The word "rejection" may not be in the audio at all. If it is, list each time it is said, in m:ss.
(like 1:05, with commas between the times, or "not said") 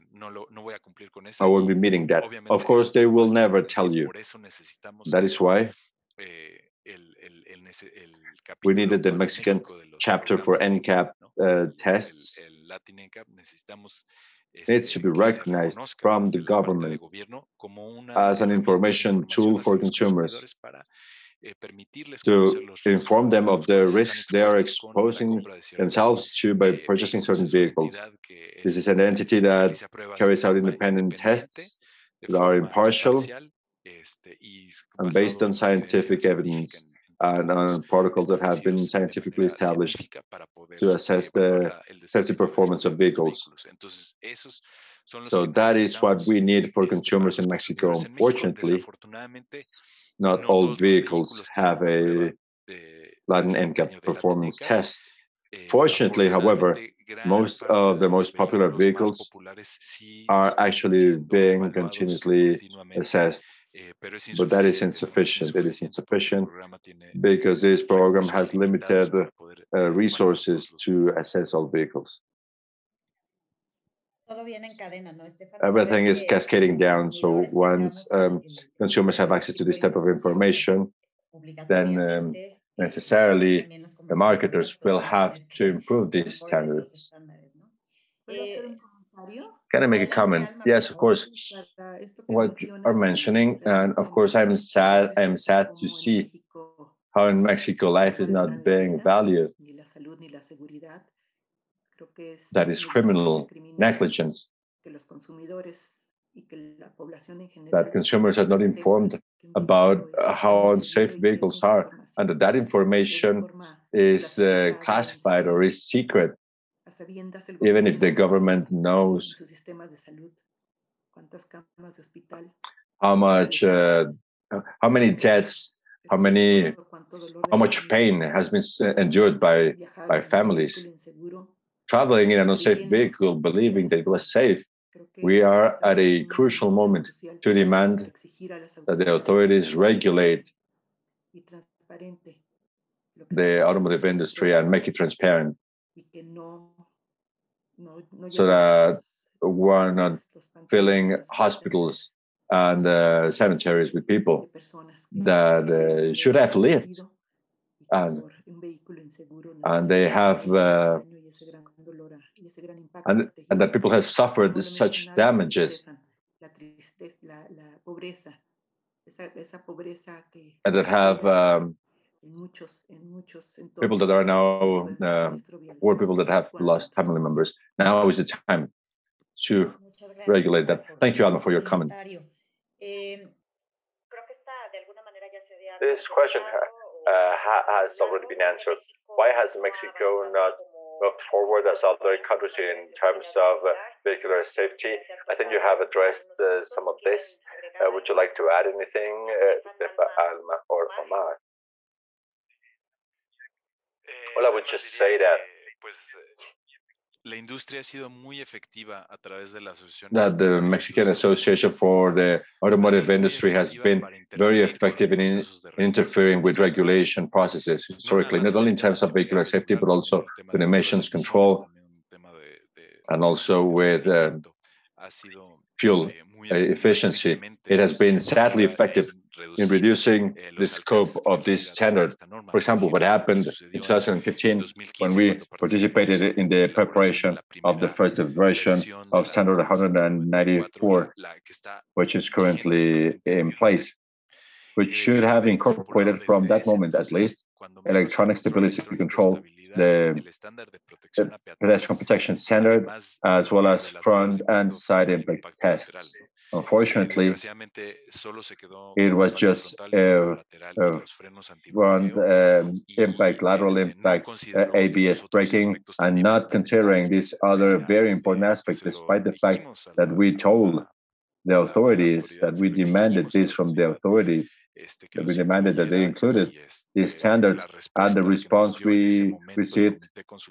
not said.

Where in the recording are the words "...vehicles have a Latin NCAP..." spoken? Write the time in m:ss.
0:50.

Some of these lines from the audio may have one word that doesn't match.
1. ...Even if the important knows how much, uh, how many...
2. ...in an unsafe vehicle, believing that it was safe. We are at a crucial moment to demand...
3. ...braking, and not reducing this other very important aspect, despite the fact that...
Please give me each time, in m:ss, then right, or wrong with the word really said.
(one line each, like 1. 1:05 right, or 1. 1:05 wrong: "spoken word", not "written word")
1. 1:57 wrong: "government", not "important"
2. 2:12 right
3. 4:25 wrong: "considering", not "reducing".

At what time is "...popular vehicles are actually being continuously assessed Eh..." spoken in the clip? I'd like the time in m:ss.
0:58.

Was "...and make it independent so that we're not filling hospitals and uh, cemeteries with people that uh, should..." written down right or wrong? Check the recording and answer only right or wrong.
wrong.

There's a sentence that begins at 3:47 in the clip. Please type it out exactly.
It has been sadly effective in reducing the scope of this standard.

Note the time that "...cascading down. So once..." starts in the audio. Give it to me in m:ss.
1:16.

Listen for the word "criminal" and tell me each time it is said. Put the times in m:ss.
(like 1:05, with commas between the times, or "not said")
1:42.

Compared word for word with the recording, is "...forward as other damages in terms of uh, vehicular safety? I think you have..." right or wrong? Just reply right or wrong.
wrong.